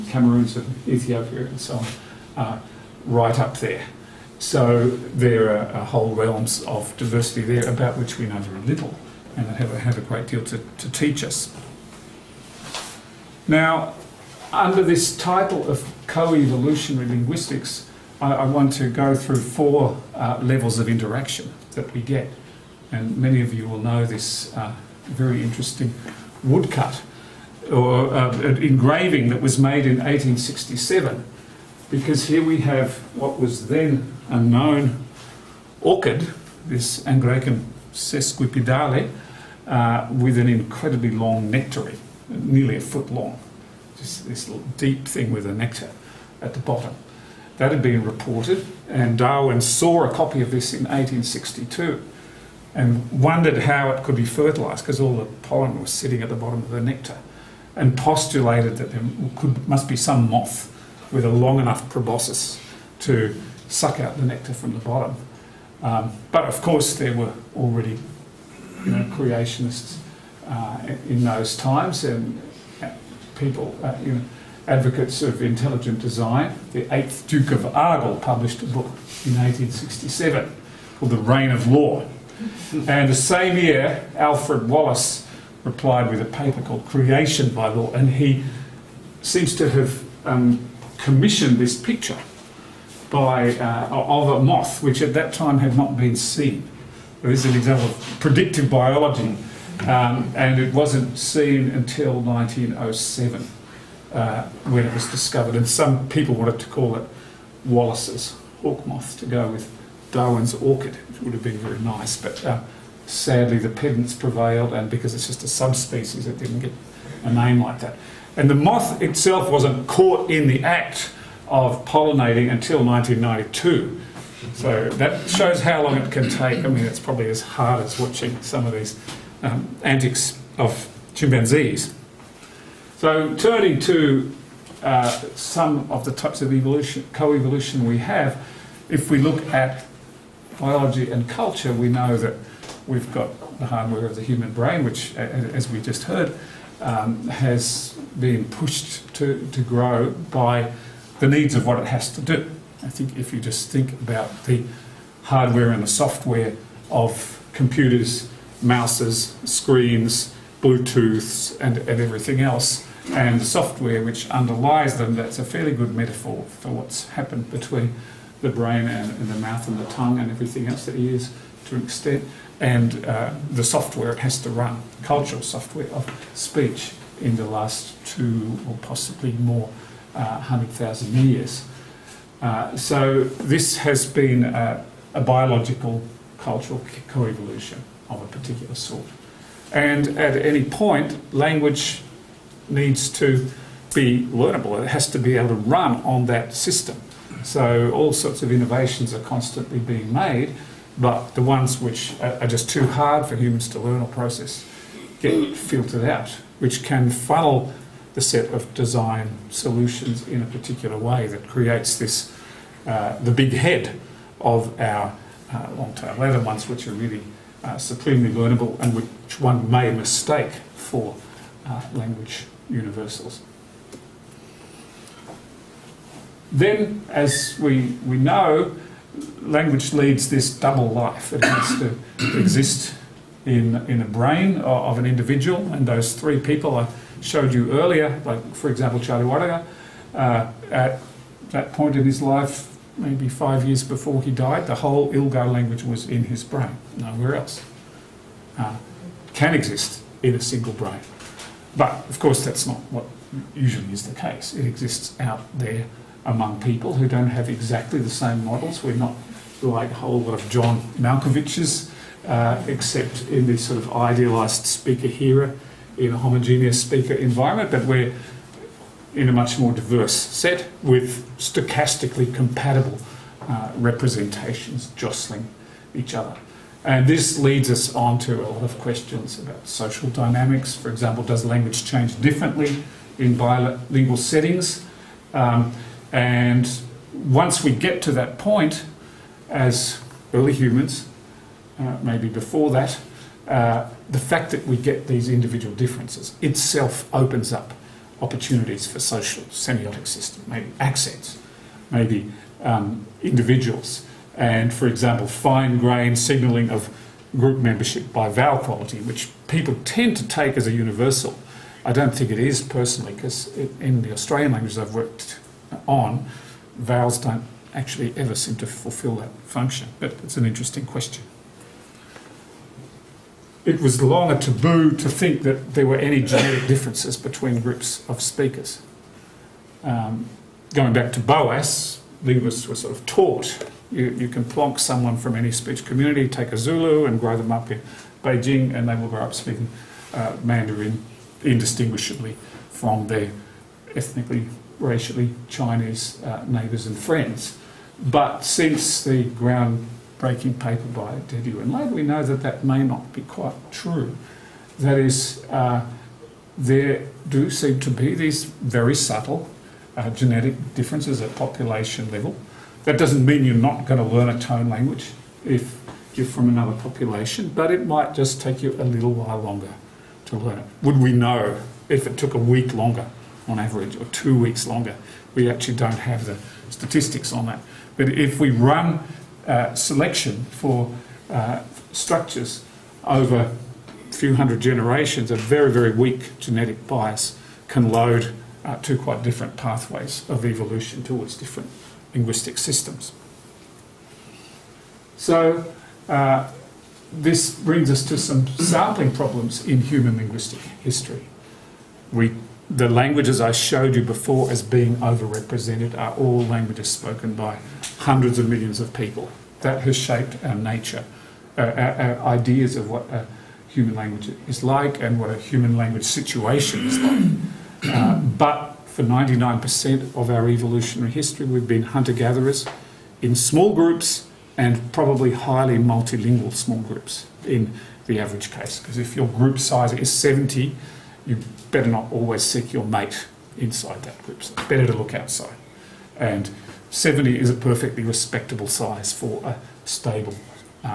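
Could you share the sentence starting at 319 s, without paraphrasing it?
But it's an interesting question it was long a taboo to think that there were any genetic differences between groups of speakers.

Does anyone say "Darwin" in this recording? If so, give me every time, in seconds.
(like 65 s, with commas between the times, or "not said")
49 s, 110 s.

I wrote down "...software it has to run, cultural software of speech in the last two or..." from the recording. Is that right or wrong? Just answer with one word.
right.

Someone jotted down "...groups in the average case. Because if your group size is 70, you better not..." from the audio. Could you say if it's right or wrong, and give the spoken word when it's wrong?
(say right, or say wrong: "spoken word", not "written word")
right.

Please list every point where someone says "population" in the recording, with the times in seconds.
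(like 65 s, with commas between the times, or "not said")
361 s, 366 s.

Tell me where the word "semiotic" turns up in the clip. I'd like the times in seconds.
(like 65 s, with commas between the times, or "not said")
299 s.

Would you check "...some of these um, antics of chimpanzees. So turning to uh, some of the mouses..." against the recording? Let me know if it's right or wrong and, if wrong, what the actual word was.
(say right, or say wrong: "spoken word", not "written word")
wrong: "types", not "mouses".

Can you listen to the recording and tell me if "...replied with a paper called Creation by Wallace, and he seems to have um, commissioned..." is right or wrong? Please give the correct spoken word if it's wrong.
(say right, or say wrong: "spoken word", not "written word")
wrong: "Law", not "Wallace".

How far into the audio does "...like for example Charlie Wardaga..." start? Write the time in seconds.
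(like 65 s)
238 s.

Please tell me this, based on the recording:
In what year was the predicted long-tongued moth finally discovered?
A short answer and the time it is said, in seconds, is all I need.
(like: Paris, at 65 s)
1907, at 102 s.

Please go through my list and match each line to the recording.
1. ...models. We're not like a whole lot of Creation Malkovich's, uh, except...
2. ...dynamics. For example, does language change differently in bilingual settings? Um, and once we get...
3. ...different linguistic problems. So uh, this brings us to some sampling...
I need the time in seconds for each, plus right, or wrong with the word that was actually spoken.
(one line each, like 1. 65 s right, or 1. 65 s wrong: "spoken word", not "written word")
1. 258 s wrong: "John", not "Creation"
2. 280 s right
3. 391 s wrong: "systems", not "problems".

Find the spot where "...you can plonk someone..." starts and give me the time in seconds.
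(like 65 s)
334 s.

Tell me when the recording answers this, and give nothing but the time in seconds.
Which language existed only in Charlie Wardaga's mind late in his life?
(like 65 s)
245 s.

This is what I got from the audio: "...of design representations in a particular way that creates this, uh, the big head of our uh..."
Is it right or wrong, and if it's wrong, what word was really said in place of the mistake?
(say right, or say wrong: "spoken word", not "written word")
wrong: "solutions", not "representations".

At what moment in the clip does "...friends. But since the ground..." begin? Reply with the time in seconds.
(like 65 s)
346 s.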